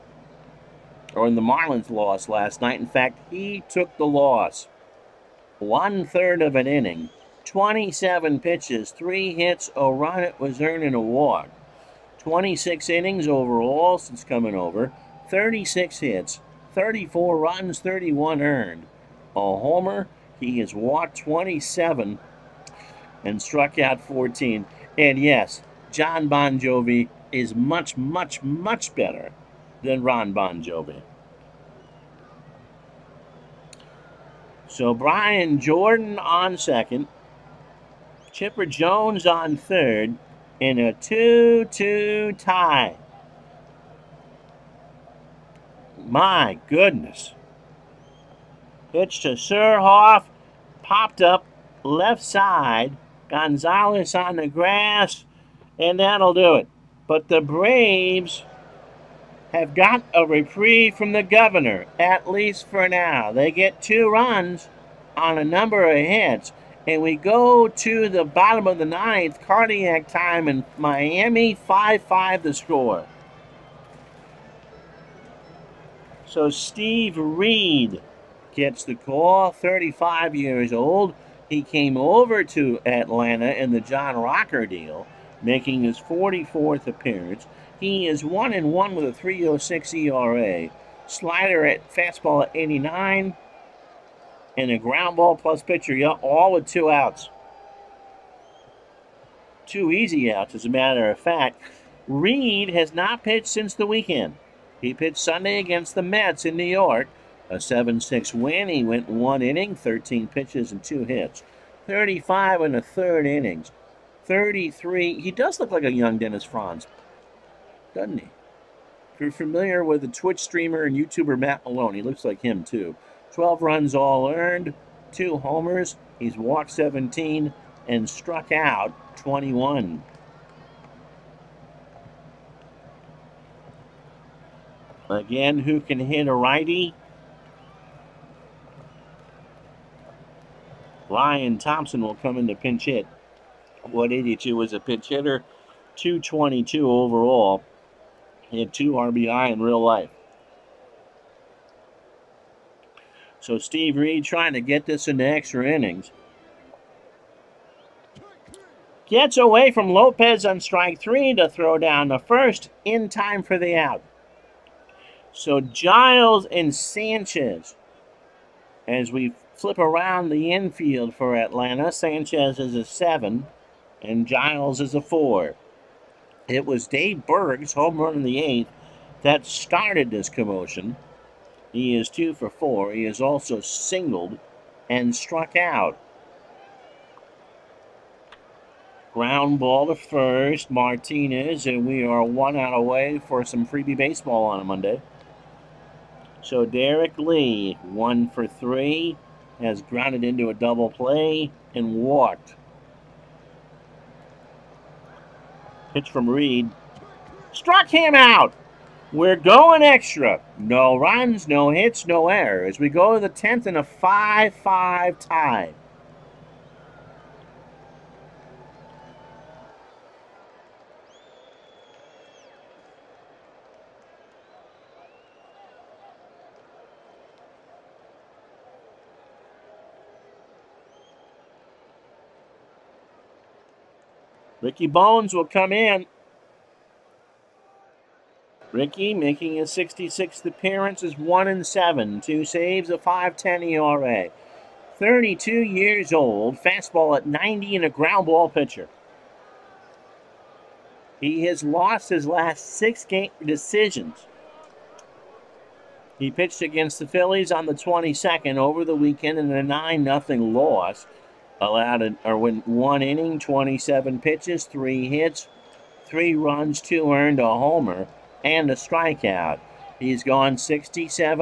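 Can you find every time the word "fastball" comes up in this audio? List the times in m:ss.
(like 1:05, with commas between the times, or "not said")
1:31, 4:06.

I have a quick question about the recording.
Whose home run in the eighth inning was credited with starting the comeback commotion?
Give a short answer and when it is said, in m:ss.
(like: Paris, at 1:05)
Dave Berg, at 2:56.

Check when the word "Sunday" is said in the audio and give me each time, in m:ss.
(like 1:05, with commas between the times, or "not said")
1:45.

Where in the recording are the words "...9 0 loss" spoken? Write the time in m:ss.
4:19.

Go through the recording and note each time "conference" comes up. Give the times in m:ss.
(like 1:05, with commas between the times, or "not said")
not said.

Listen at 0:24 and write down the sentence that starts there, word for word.
And yes, Jon Bon Jovi is much, much, much better than Ron Bon Jovi.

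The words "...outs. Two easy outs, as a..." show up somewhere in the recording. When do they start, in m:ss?
1:36.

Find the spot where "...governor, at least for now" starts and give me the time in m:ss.
1:01.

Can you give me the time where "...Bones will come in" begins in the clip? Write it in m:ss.
3:54.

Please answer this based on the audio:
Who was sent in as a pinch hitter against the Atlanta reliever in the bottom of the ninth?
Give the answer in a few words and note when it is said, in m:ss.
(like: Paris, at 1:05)
Ryan Thompson, at 2:21.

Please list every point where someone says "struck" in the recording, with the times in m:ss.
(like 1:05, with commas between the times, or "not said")
0:23, 2:08, 3:05, 3:27.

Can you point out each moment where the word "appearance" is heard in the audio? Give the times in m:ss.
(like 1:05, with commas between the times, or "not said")
1:26, 4:00.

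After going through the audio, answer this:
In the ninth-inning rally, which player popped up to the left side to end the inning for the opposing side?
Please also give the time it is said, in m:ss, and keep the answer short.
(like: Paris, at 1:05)
Surhoff, at 0:49.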